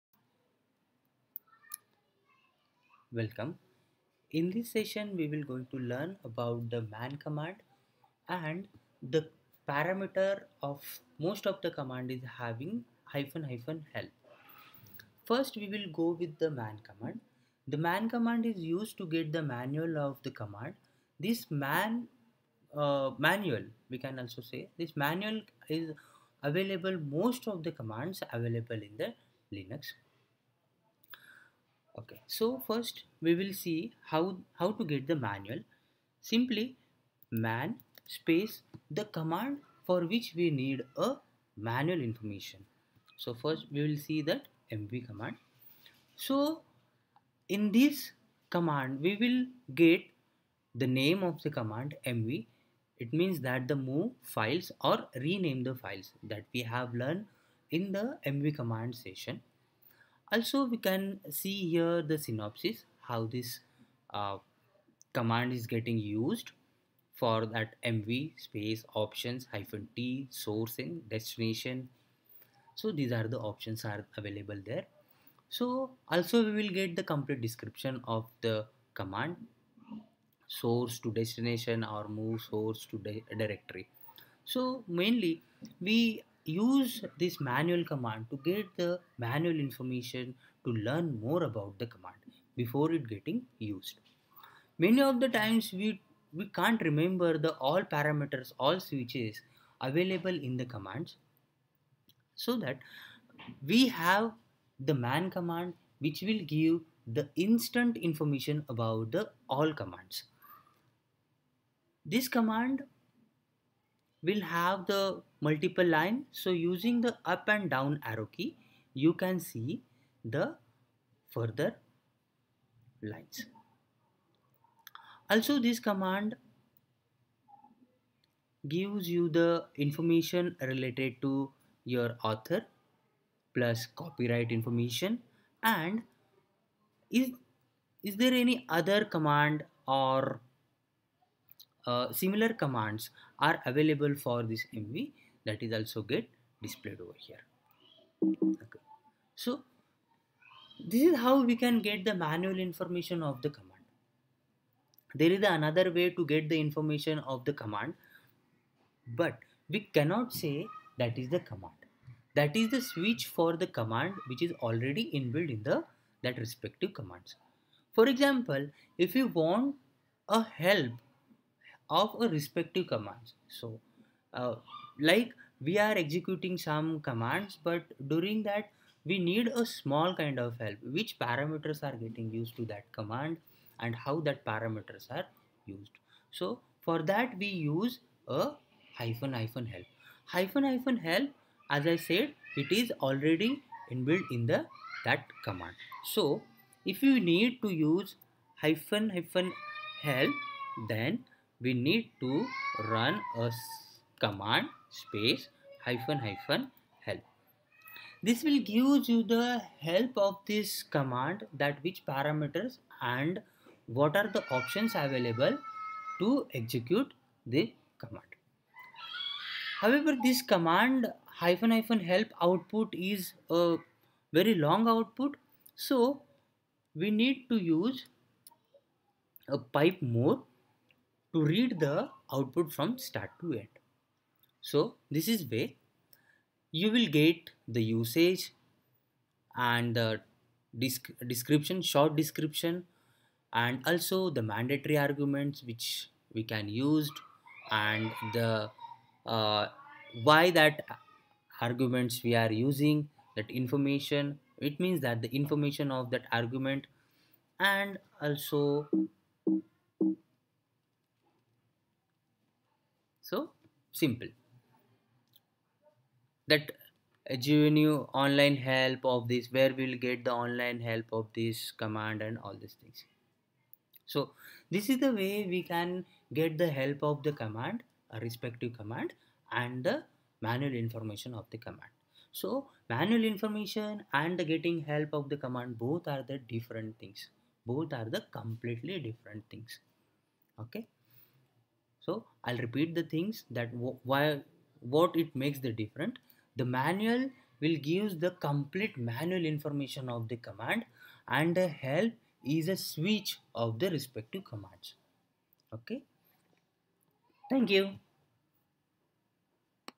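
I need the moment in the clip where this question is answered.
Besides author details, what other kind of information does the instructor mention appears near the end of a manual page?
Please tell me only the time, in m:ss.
2:13.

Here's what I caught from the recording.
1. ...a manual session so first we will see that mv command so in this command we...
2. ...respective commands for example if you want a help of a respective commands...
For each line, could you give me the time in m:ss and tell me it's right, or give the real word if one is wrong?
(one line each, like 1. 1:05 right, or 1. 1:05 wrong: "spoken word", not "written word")
1. 0:40 wrong: "information", not "session"
2. 2:46 right.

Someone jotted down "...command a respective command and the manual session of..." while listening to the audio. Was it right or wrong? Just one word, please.
wrong.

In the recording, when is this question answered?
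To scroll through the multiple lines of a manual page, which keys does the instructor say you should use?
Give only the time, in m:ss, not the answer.
1:57.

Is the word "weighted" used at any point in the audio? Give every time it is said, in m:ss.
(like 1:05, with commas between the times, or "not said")
not said.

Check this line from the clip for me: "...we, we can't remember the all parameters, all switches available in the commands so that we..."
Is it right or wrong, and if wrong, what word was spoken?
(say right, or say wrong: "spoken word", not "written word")
right.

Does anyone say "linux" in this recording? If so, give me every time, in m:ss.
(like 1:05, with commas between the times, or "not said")
0:29.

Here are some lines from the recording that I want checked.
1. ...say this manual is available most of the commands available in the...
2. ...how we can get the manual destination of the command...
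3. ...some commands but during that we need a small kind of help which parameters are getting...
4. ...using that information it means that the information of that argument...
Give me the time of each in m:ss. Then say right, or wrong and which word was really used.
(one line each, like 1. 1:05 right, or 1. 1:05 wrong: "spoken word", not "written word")
1. 0:24 right
2. 2:31 wrong: "information", not "destination"
3. 2:56 right
4. 4:12 right.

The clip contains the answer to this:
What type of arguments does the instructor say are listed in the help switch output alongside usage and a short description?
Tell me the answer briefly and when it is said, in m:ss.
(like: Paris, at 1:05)
mandatory arguments, at 4:04.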